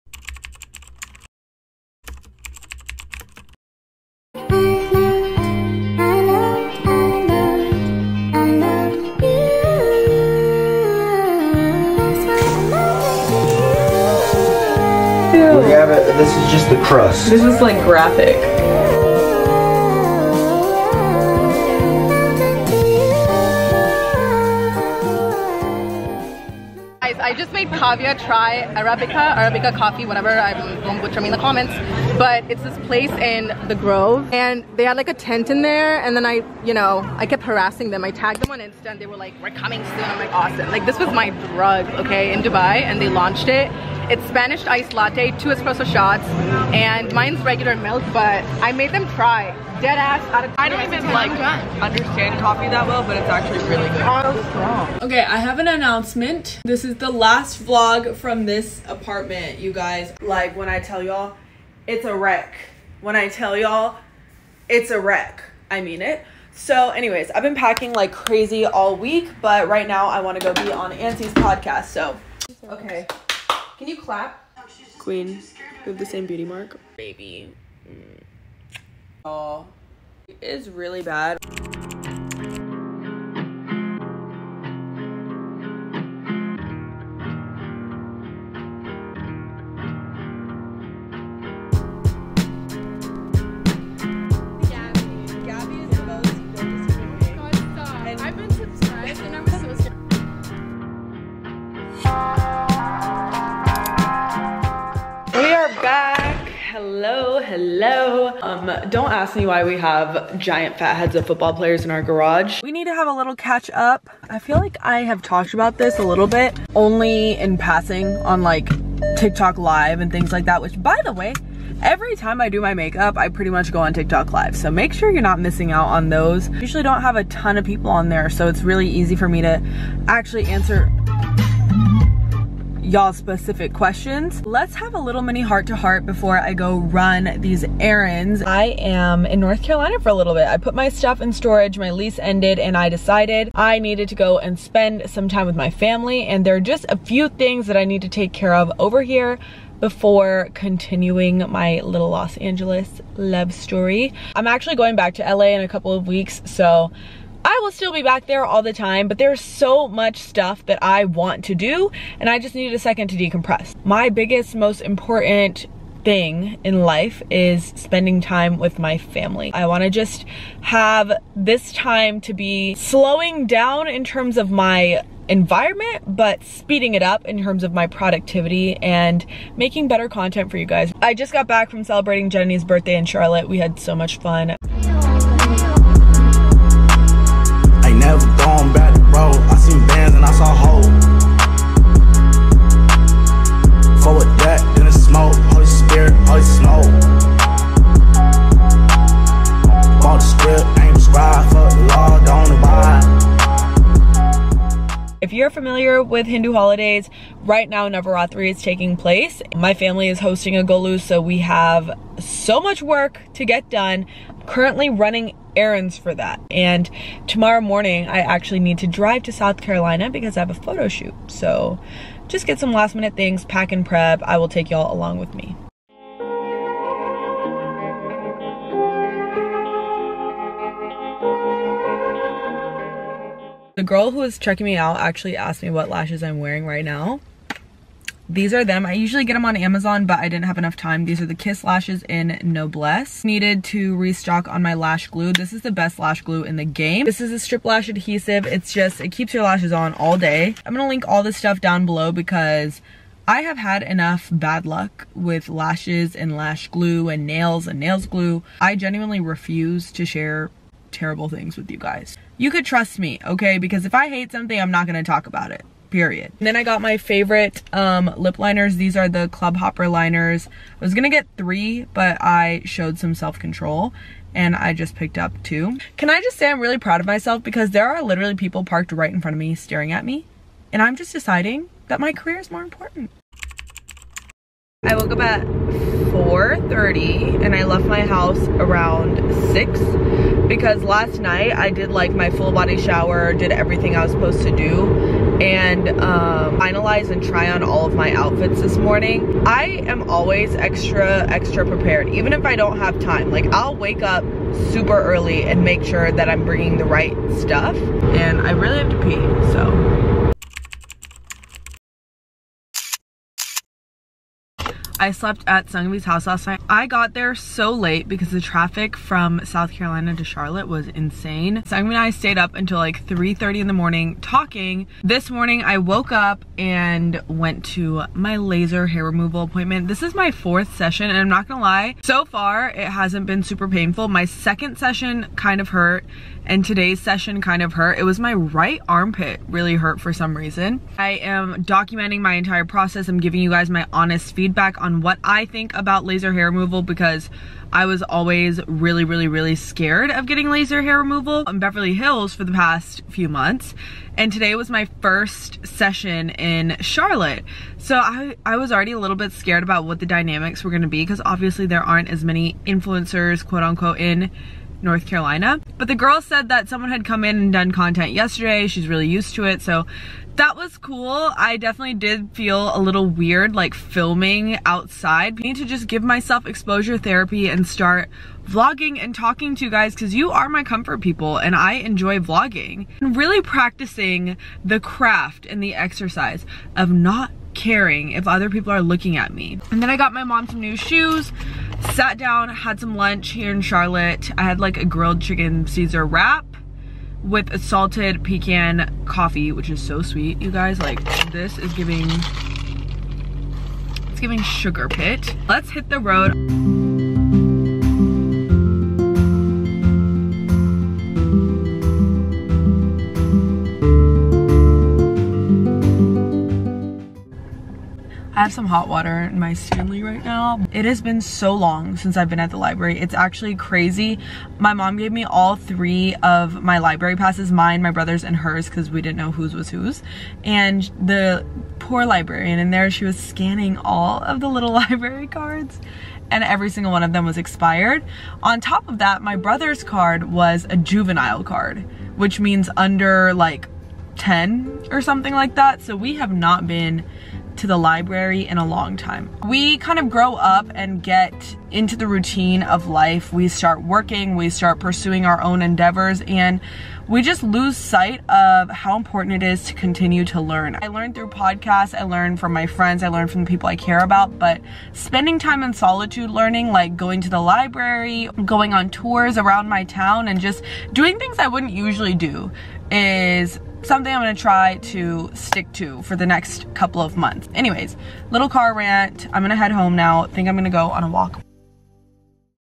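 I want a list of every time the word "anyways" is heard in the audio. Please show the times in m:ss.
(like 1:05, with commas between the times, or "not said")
1:06, 7:57.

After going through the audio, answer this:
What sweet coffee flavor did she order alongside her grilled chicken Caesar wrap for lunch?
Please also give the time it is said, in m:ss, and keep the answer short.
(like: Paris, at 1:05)
Salted pecan, at 6:37.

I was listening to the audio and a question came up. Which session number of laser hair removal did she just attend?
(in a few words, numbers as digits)
4th.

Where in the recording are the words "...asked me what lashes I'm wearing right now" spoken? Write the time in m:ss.
3:55.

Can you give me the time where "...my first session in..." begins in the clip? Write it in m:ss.
5:54.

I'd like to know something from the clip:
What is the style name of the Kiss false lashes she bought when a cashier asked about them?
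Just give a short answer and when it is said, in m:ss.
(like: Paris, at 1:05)
Noblesse, at 4:02.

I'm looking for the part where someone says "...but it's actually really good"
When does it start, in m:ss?
0:53.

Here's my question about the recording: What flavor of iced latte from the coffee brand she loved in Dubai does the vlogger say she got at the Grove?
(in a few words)
Spanish iced latte.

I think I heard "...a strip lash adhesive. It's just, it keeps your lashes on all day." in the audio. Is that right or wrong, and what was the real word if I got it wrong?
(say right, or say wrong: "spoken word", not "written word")
right.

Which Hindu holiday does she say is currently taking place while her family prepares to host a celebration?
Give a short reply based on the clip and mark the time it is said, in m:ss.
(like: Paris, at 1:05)
Navaratri, at 3:27.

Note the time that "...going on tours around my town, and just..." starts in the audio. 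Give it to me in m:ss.
7:48.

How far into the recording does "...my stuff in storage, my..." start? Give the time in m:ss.
2:20.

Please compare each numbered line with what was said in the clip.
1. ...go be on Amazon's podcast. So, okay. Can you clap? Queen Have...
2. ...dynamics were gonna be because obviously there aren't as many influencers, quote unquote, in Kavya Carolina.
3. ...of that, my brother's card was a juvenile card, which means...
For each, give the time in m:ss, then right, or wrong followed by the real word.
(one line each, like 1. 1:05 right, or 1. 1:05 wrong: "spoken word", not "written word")
1. 1:10 wrong: "Ansie", not "Amazon"
2. 6:00 wrong: "North", not "Kavya"
3. 7:18 right.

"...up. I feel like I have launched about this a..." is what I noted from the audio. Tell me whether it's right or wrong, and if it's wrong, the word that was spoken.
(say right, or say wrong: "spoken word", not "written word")
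wrong: "talked", not "launched".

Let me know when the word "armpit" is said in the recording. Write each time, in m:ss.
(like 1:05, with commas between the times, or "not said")
5:38.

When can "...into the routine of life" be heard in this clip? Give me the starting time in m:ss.
7:31.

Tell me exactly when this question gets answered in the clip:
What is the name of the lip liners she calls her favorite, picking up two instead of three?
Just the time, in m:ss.
4:29.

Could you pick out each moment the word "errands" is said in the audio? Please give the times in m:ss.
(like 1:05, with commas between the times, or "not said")
2:17, 3:35.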